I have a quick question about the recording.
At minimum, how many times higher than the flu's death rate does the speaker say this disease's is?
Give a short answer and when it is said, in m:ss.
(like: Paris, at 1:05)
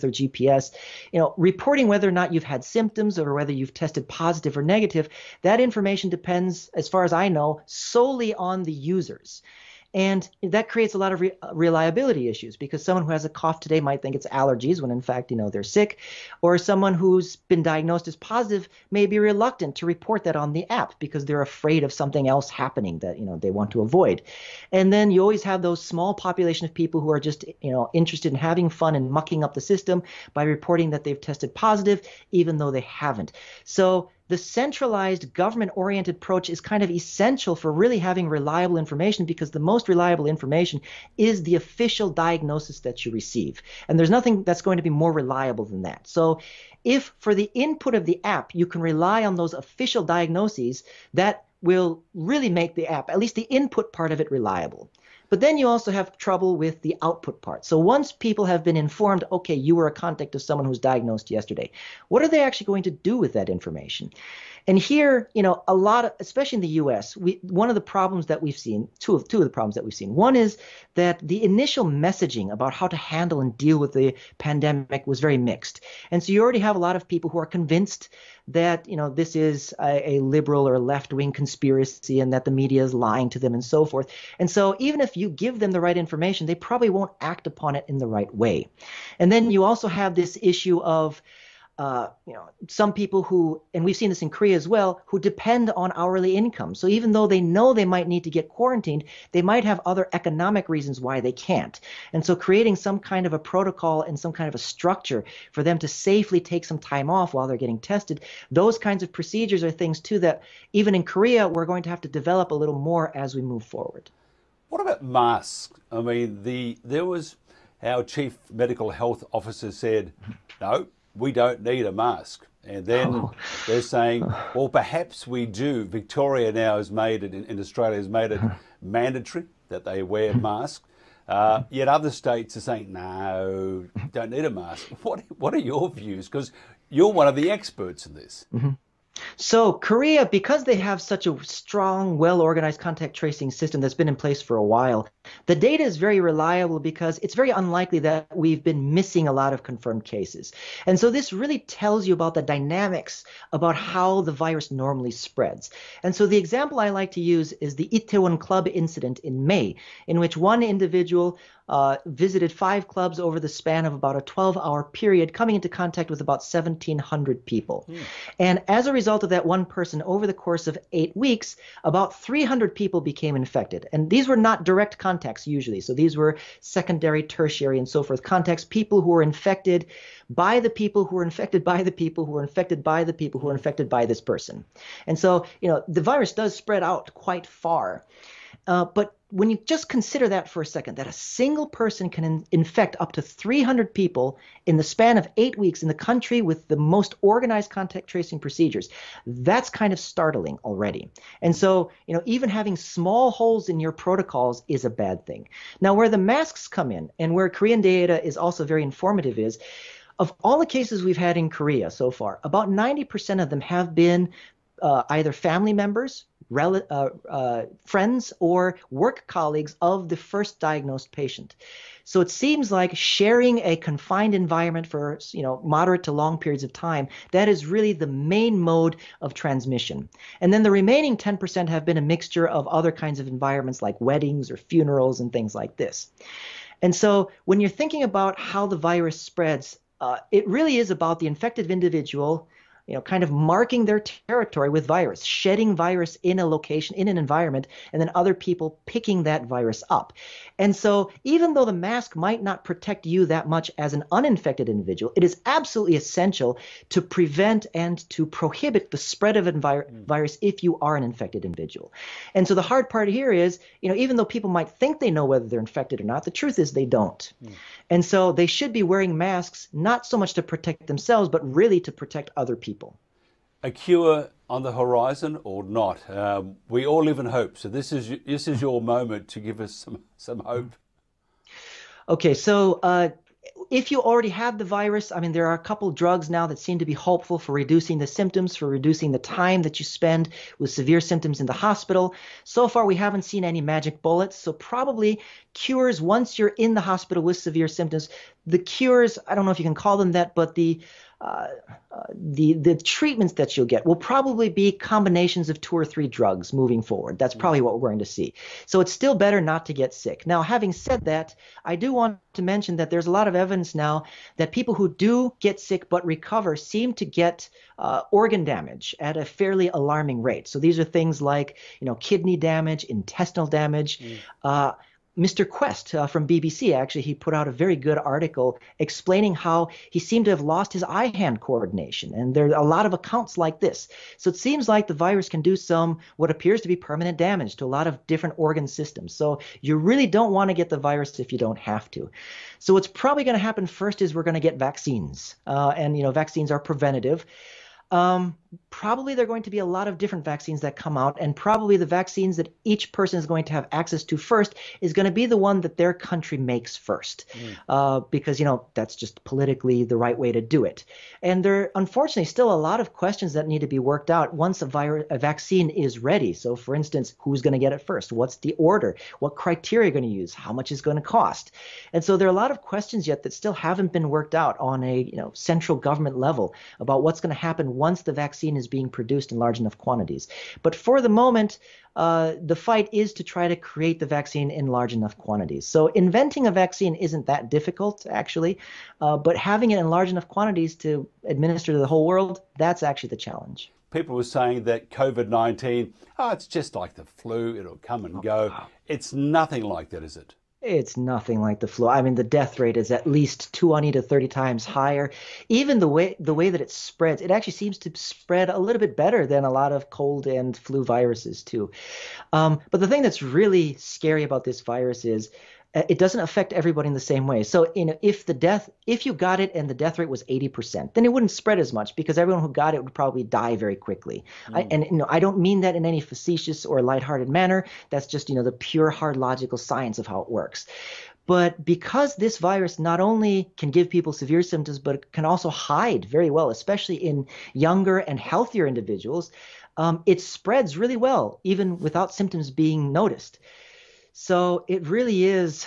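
20 to 30 times, at 6:43.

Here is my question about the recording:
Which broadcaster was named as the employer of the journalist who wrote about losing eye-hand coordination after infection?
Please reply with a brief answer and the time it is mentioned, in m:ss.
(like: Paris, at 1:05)
BBC, at 5:26.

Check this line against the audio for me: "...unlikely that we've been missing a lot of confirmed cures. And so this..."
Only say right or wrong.
wrong.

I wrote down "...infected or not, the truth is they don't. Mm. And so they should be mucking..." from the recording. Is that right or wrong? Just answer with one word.
wrong.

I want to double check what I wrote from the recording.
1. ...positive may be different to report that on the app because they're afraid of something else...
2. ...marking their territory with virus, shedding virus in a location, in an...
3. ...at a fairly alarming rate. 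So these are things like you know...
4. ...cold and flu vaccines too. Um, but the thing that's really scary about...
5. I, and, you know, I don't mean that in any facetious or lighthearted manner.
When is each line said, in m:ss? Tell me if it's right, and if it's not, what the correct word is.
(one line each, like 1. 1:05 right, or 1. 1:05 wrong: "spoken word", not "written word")
1. 0:18 wrong: "reluctant", not "different"
2. 4:03 right
3. 5:18 right
4. 6:49 wrong: "viruses", not "vaccines"
5. 7:04 right.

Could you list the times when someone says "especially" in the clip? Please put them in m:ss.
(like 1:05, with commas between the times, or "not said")
1:06, 7:16.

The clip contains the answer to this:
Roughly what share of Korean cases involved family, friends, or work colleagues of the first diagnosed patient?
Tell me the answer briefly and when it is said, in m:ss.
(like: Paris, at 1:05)
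90%, at 3:32.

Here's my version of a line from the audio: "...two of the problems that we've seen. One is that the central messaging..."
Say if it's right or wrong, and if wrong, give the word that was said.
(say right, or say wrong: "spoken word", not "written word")
wrong: "initial", not "central".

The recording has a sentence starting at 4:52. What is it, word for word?
So far, we haven't seen any magic bullets.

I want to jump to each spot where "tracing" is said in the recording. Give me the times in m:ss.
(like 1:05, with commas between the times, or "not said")
2:23, 3:18.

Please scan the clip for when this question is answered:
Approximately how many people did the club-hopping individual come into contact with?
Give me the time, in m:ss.
2:46.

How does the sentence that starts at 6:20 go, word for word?
But for the moment, uh, the fight is to try to create the vaccine in large enough quantities.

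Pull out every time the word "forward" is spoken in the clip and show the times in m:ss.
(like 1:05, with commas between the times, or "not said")
1:53, 5:06.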